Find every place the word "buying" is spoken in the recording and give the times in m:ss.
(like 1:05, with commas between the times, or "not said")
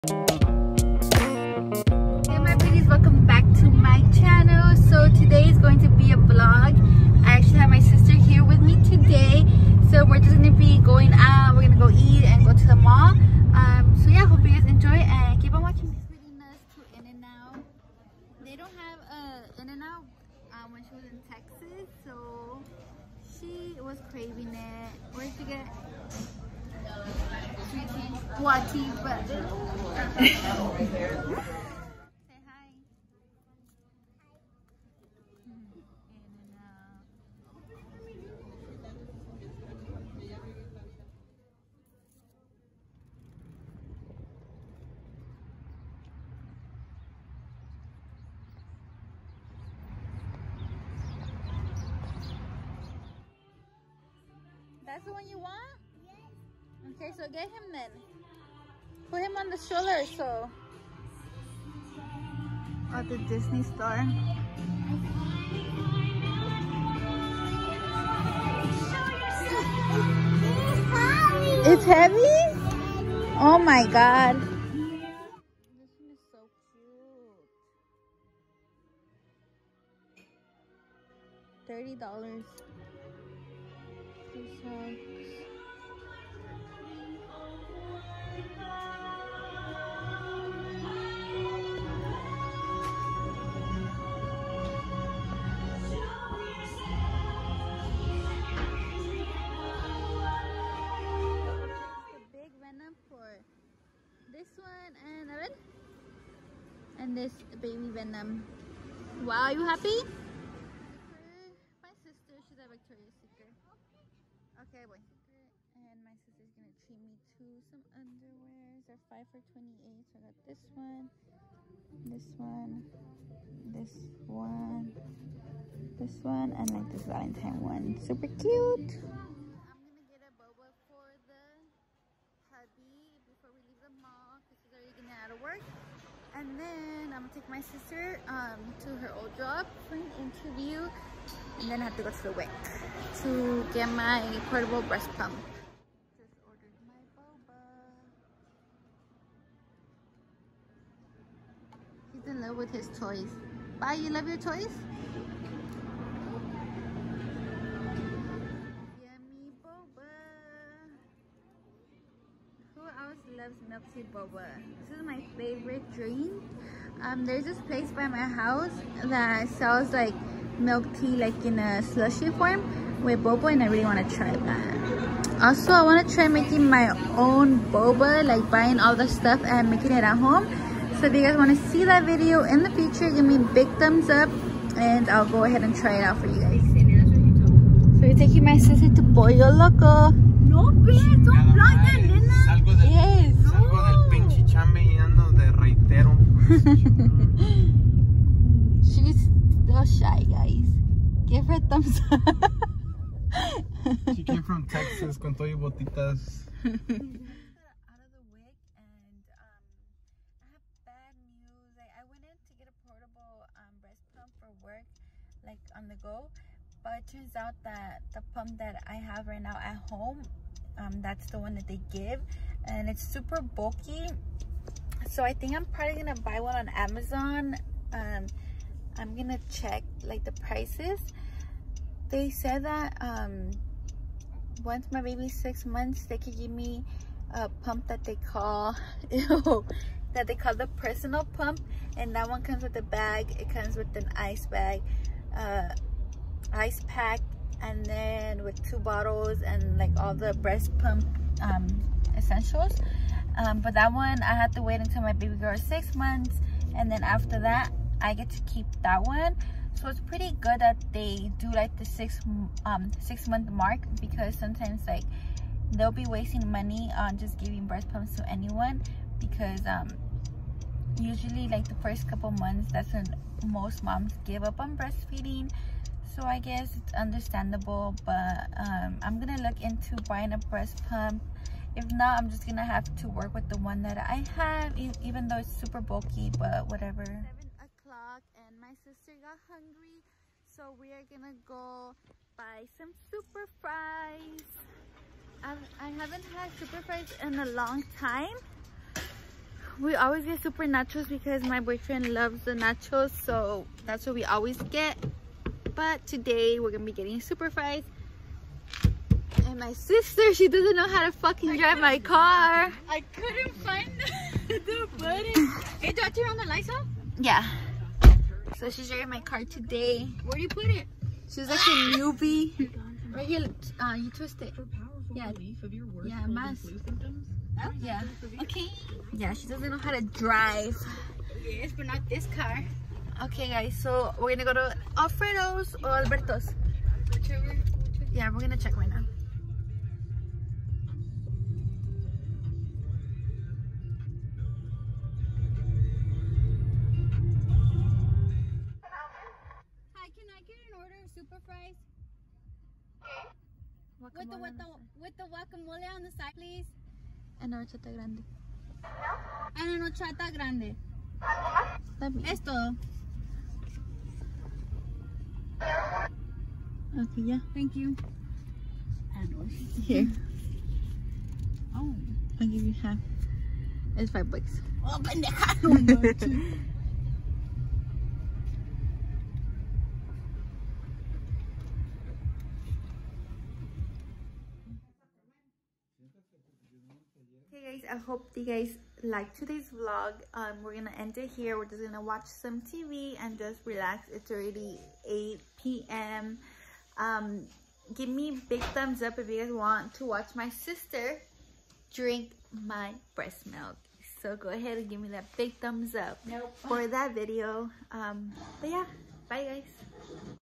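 2:58, 4:40.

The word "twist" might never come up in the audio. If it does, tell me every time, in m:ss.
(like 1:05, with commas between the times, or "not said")
5:24.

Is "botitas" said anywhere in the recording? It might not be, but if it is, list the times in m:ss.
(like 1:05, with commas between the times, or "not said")
3:25.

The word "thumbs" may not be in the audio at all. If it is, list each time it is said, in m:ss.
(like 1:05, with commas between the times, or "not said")
3:03, 3:21, 6:38, 6:45.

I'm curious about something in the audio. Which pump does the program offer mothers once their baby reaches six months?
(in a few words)
personal pump.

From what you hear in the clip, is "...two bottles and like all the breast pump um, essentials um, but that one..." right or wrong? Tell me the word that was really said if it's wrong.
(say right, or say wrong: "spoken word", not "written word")
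right.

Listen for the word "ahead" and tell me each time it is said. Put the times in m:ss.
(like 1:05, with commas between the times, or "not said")
3:05, 6:44.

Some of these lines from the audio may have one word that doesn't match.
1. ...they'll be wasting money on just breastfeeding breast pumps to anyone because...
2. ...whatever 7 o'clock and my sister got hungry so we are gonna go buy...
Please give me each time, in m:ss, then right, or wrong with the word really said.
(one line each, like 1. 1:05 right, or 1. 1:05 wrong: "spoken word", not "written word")
1. 4:25 wrong: "giving", not "breastfeeding"
2. 4:46 right.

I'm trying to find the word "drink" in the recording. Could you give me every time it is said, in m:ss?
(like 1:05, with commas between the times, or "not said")
2:45, 6:41.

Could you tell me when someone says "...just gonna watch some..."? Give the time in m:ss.
6:31.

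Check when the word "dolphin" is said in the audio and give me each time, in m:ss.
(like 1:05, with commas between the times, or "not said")
not said.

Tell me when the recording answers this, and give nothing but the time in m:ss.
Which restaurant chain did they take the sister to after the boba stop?
3:09.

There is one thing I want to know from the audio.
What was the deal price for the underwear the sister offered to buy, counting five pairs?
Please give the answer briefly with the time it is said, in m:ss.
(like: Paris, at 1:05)
$28, at 1:59.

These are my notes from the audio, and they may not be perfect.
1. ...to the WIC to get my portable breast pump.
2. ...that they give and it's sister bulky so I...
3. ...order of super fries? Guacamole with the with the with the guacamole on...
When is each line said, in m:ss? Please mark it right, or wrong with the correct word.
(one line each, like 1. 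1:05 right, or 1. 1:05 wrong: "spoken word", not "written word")
1. 2:22 right
2. 3:41 wrong: "super", not "sister"
3. 5:50 right.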